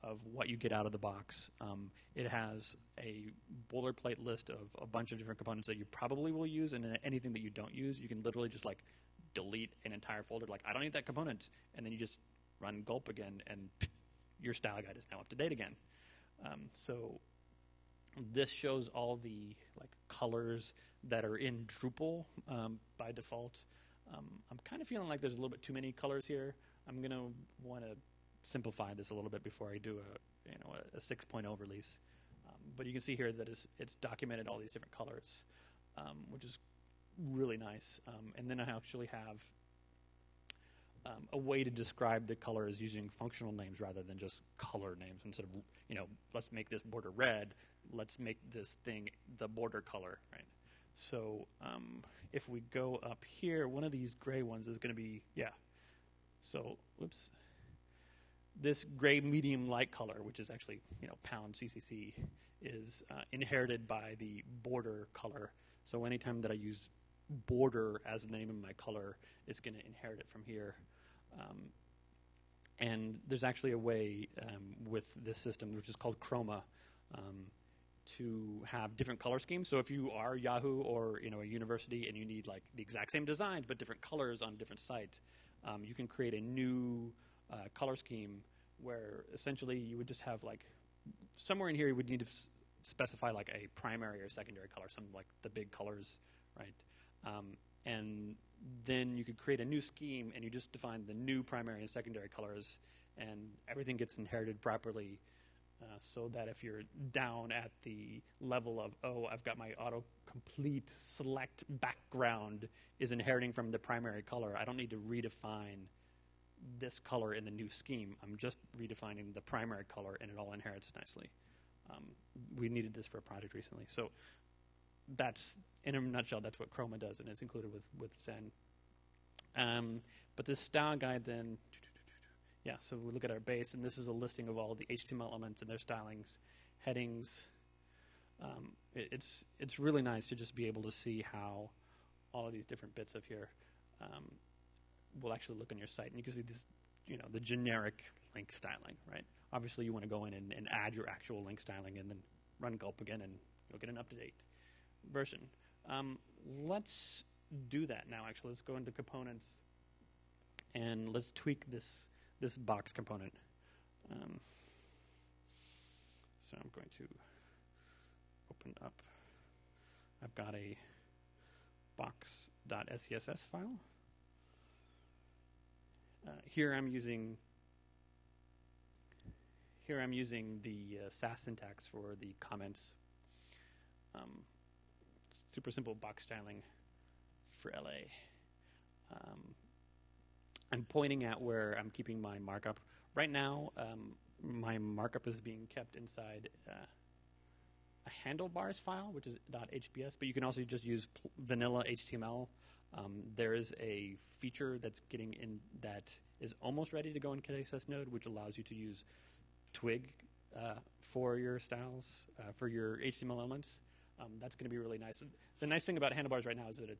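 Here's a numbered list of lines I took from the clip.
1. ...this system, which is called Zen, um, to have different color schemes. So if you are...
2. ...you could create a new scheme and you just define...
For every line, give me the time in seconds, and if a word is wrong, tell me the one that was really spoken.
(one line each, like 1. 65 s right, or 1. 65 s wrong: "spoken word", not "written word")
1. 75 s wrong: "Chroma", not "Zen"
2. 99 s right.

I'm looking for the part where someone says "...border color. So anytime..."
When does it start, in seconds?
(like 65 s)
64 s.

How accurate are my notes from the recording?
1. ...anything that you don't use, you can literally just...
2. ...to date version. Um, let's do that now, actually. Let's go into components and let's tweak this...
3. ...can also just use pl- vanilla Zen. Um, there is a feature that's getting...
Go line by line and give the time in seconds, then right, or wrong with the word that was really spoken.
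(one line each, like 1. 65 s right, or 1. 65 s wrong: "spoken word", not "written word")
1. 7 s right
2. 154 s right
3. 200 s wrong: "HTML", not "Zen".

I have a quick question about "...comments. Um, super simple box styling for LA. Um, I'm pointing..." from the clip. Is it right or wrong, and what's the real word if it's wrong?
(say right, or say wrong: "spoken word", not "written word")
right.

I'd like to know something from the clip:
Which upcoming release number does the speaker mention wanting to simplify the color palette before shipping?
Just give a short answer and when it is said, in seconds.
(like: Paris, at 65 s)
6.0, at 30 s.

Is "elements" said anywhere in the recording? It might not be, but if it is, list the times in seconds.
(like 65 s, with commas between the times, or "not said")
135 s, 213 s.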